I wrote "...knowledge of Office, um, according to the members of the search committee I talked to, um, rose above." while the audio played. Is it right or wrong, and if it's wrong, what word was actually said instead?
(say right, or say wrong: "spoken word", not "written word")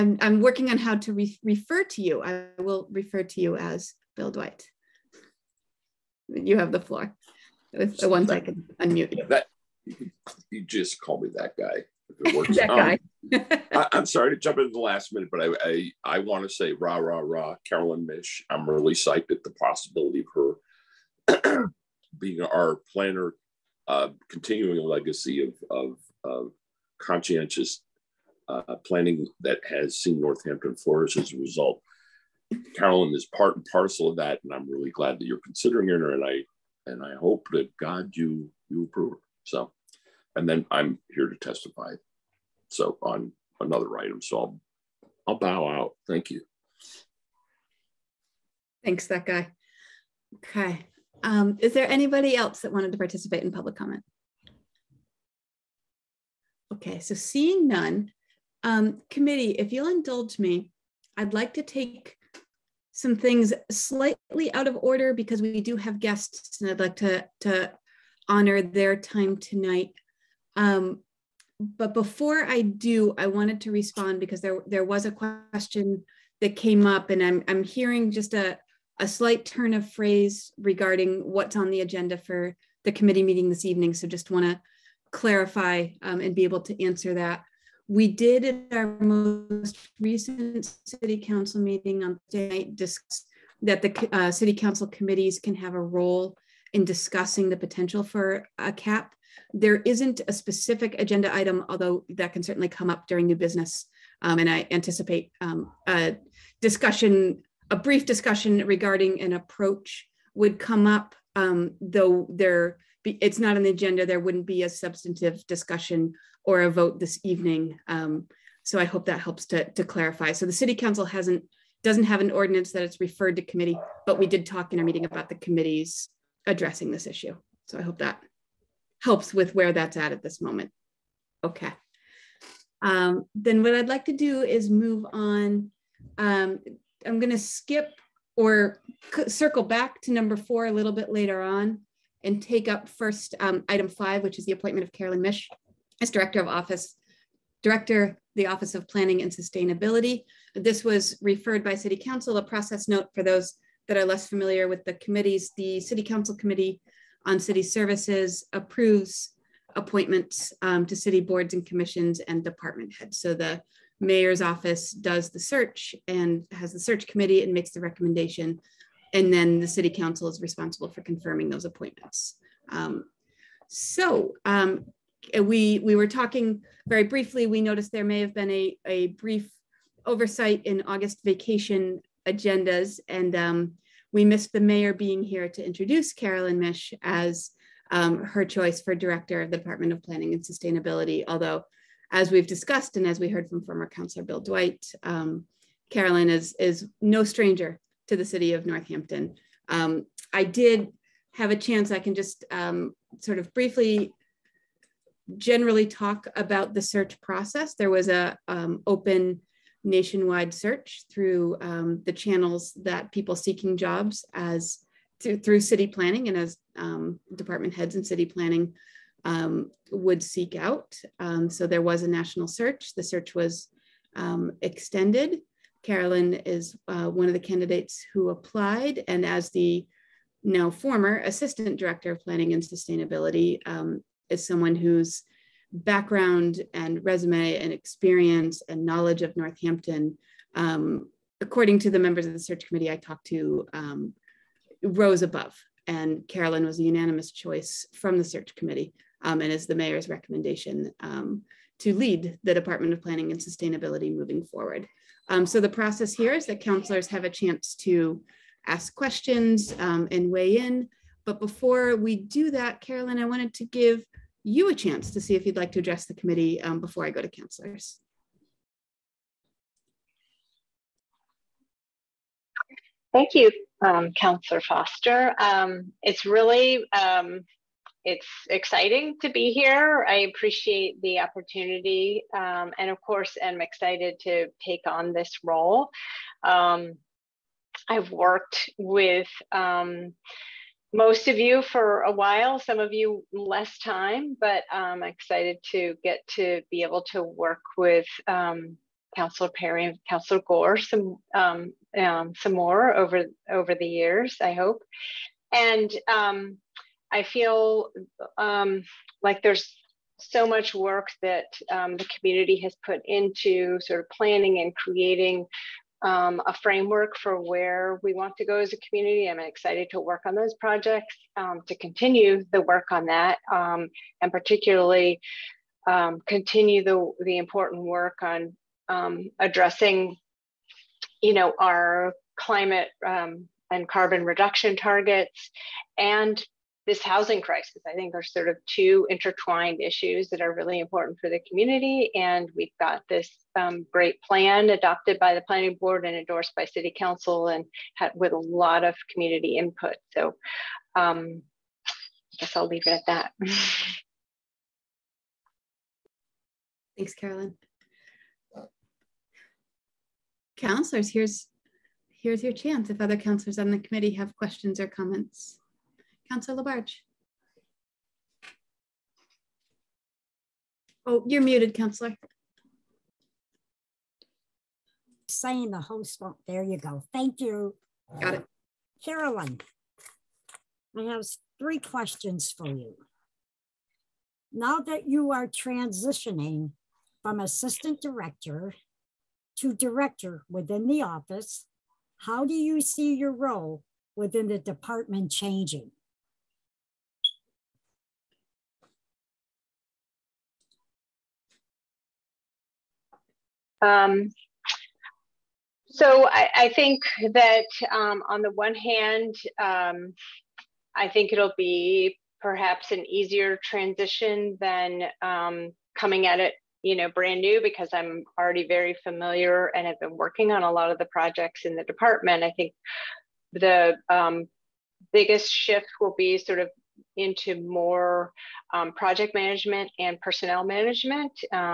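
wrong: "Northampton", not "Office".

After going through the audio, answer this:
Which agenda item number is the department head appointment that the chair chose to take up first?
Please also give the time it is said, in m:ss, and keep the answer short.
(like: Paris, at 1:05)
5, at 2:23.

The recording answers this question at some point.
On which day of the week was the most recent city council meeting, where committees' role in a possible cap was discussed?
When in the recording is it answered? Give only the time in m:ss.
1:32.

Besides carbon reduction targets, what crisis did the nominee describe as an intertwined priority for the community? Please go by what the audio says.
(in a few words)
housing crisis.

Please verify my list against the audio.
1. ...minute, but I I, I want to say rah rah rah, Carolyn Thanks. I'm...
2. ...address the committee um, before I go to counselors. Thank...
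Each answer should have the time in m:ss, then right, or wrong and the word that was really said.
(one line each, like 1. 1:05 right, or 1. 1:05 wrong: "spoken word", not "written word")
1. 0:15 wrong: "Mish", not "Thanks"
2. 4:25 right.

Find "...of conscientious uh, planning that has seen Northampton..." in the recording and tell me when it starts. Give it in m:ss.
0:26.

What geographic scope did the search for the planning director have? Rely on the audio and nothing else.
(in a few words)
nationwide.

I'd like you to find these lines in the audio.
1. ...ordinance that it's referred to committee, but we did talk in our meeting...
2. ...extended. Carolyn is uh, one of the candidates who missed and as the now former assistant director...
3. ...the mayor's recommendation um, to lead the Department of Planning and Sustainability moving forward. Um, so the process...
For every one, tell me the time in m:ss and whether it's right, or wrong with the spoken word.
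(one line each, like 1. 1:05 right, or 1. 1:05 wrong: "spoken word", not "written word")
1. 2:02 right
2. 3:44 wrong: "applied", not "missed"
3. 4:09 right.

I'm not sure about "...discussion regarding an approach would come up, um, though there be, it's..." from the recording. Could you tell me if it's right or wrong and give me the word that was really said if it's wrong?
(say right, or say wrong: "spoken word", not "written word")
right.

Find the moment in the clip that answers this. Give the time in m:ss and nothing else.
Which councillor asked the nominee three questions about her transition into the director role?
6:06.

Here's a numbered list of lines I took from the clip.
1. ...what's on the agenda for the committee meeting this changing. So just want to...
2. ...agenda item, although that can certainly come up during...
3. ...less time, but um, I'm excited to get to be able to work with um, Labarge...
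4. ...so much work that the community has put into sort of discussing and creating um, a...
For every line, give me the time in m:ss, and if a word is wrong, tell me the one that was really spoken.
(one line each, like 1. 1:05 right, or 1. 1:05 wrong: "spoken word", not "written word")
1. 1:21 wrong: "evening", not "changing"
2. 1:40 right
3. 4:53 wrong: "Councillor", not "Labarge"
4. 5:10 wrong: "planning", not "discussing".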